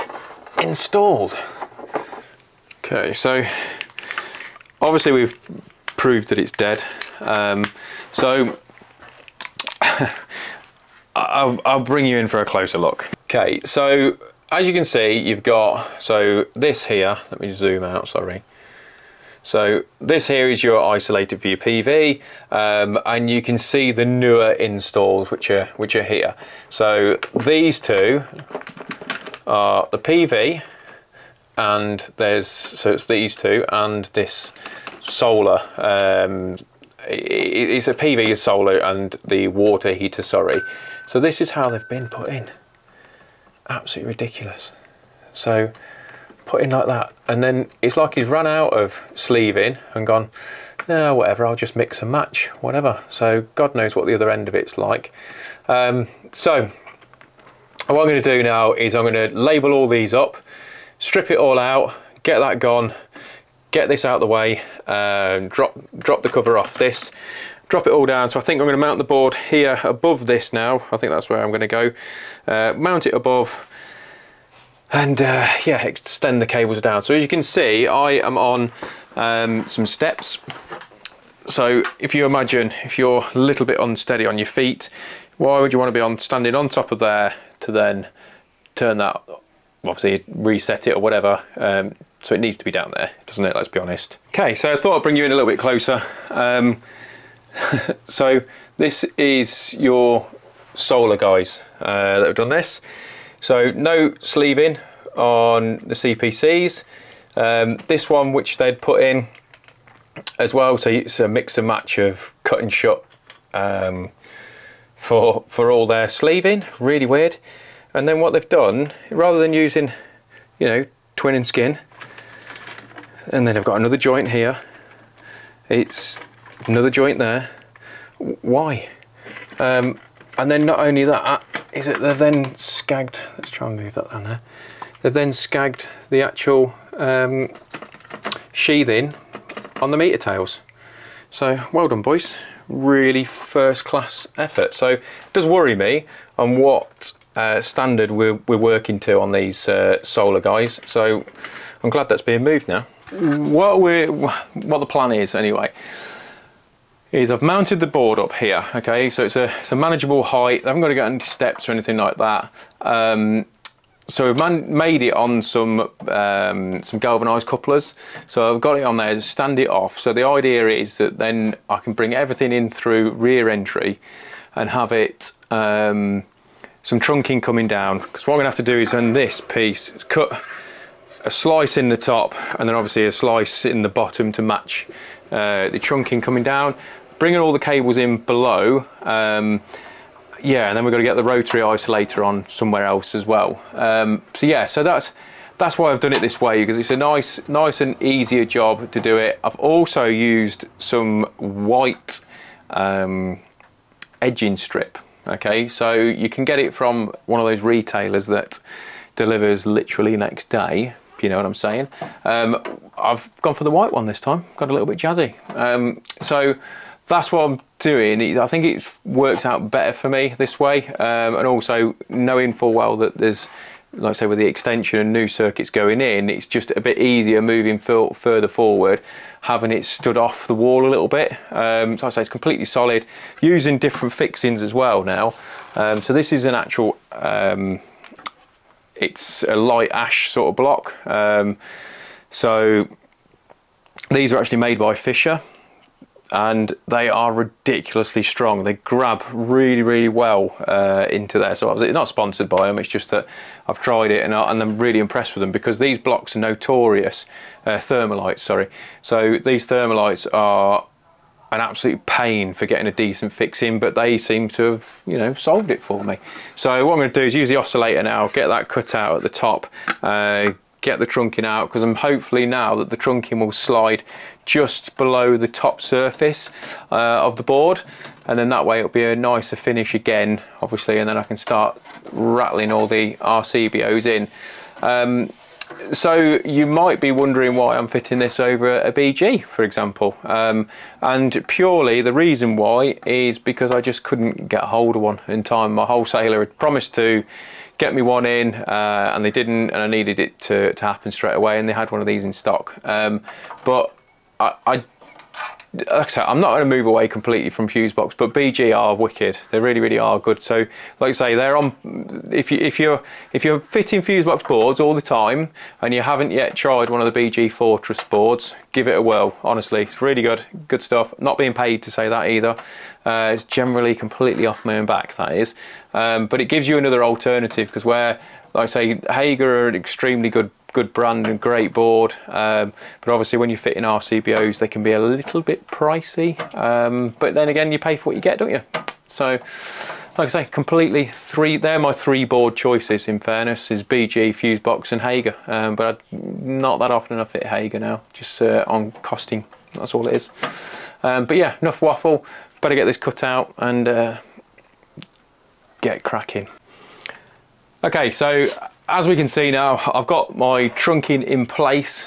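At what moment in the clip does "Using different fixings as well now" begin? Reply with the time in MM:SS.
03:53.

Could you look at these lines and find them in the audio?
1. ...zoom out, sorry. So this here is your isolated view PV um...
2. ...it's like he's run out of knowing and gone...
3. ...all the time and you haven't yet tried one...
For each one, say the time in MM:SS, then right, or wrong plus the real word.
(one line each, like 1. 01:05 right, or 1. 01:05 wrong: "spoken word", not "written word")
1. 00:17 right
2. 00:47 wrong: "sleeving", not "knowing"
3. 05:14 right.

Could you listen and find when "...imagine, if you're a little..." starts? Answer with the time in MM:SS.
01:22.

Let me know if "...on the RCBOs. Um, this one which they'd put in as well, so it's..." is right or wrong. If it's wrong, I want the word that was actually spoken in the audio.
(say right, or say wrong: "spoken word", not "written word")
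wrong: "CPCs", not "RCBOs".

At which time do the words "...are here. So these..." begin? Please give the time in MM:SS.
00:25.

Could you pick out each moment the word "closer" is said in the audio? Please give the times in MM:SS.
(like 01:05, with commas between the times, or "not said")
00:12, 01:35.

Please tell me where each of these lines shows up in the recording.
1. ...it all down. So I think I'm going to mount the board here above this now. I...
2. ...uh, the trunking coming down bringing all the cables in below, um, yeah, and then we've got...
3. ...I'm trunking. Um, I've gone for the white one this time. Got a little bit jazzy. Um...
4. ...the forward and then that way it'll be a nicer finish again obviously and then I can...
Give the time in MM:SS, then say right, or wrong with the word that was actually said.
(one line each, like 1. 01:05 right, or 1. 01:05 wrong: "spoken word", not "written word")
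1. 01:07 right
2. 03:05 right
3. 03:31 wrong: "saying", not "trunking"
4. 04:37 wrong: "board", not "forward".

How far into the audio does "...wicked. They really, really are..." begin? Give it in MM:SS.
05:08.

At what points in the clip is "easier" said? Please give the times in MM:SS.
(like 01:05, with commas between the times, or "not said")
03:18, 03:46.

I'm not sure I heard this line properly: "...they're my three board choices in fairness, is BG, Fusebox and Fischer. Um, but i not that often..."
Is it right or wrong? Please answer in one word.
wrong.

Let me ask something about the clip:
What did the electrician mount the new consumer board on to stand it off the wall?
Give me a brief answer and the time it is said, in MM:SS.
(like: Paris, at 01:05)
Galvanized couplers, at 02:46.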